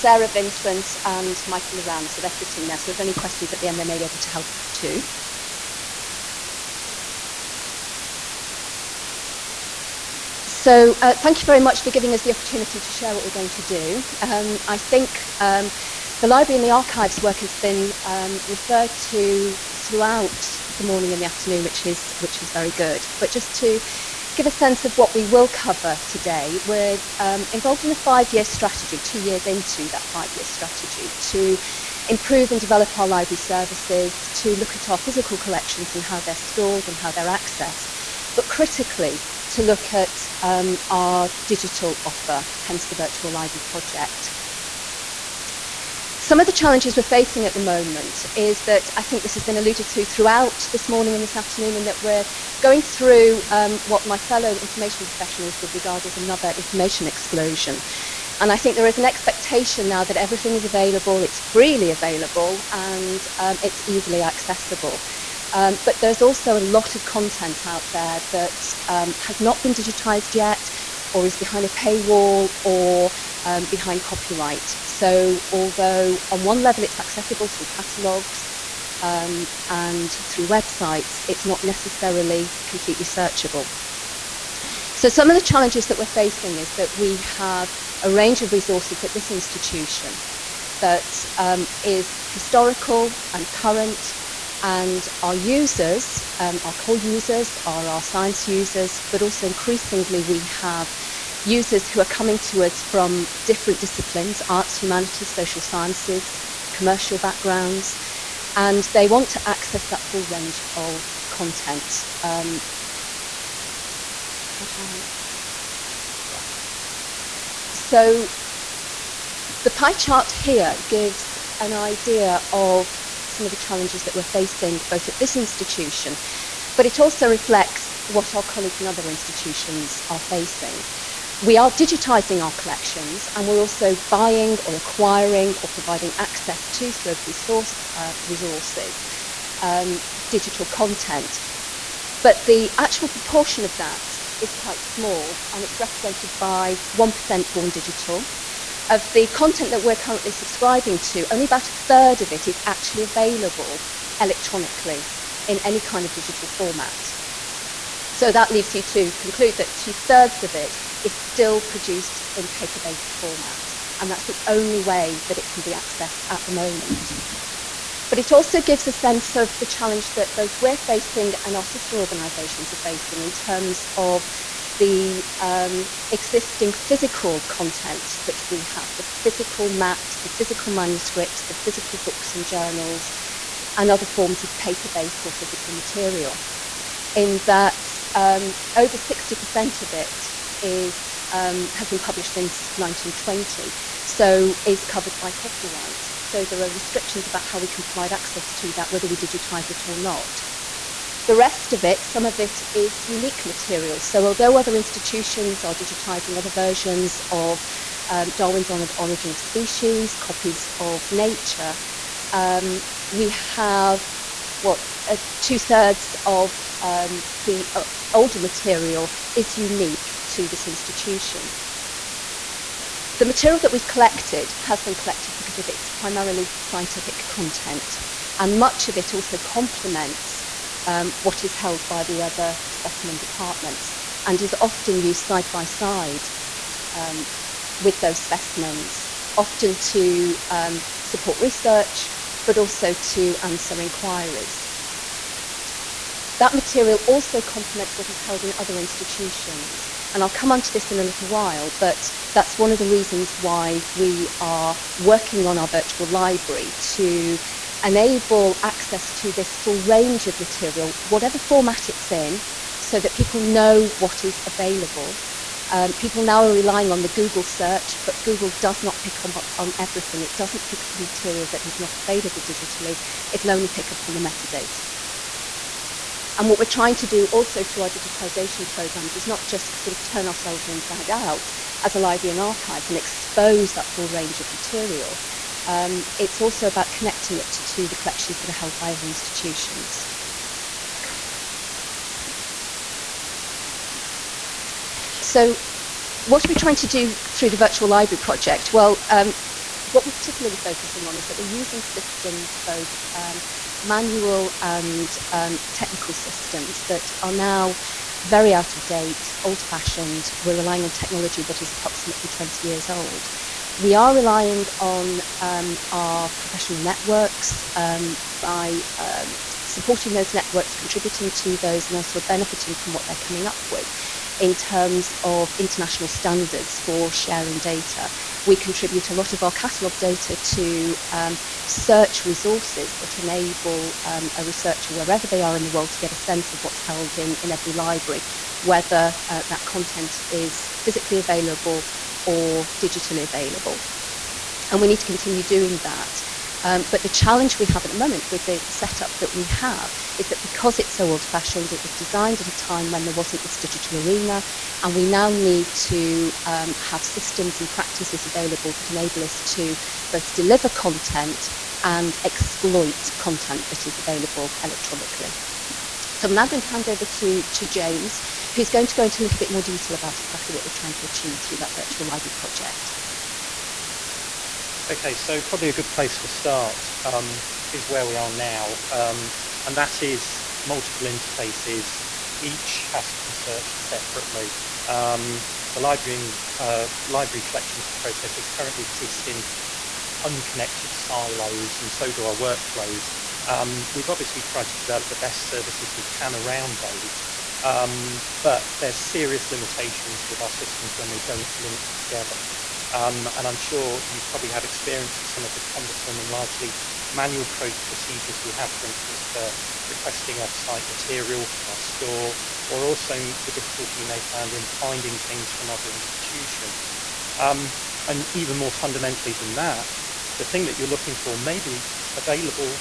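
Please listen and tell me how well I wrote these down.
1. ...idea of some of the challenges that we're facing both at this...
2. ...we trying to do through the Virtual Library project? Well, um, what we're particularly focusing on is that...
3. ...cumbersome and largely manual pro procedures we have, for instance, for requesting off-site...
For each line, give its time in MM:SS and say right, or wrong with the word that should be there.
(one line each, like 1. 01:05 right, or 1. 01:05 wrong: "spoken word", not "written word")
1. 02:01 right
2. 04:56 right
3. 06:45 right.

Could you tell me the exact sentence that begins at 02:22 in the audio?
But the actual proportion of that is quite small and it's represented by 1% born digital.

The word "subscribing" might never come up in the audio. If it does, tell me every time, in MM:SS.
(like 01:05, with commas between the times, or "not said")
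02:30.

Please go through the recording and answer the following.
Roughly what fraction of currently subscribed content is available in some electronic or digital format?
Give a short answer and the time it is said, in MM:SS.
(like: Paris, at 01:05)
A third, at 02:31.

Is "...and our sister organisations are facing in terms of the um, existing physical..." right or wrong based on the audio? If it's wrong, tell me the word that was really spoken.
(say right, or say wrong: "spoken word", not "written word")
right.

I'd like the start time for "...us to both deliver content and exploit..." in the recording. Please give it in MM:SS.
05:59.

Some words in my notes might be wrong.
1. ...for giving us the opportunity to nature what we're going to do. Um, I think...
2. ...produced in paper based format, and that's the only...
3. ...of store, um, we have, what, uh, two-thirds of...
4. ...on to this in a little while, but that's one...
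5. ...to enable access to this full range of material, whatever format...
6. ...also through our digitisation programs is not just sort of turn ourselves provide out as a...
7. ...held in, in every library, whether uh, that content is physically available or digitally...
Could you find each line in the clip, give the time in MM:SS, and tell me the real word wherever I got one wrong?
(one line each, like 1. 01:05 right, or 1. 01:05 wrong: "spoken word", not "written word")
1. 00:11 wrong: "share", not "nature"
2. 02:41 right
3. 03:30 wrong: "nature", not "store"
4. 04:10 right
5. 04:16 right
6. 04:37 wrong: "inside", not "provide"
7. 05:36 right.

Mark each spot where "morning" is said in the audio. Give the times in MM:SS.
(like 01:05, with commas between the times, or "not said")
00:20, 00:50.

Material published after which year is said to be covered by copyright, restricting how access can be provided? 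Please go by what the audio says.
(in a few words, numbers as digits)
1920.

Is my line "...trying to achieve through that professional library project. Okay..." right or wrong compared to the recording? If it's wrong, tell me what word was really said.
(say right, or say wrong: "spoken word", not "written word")
wrong: "virtual", not "professional".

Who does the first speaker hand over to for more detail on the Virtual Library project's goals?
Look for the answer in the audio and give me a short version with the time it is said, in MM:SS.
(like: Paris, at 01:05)
James, at 06:07.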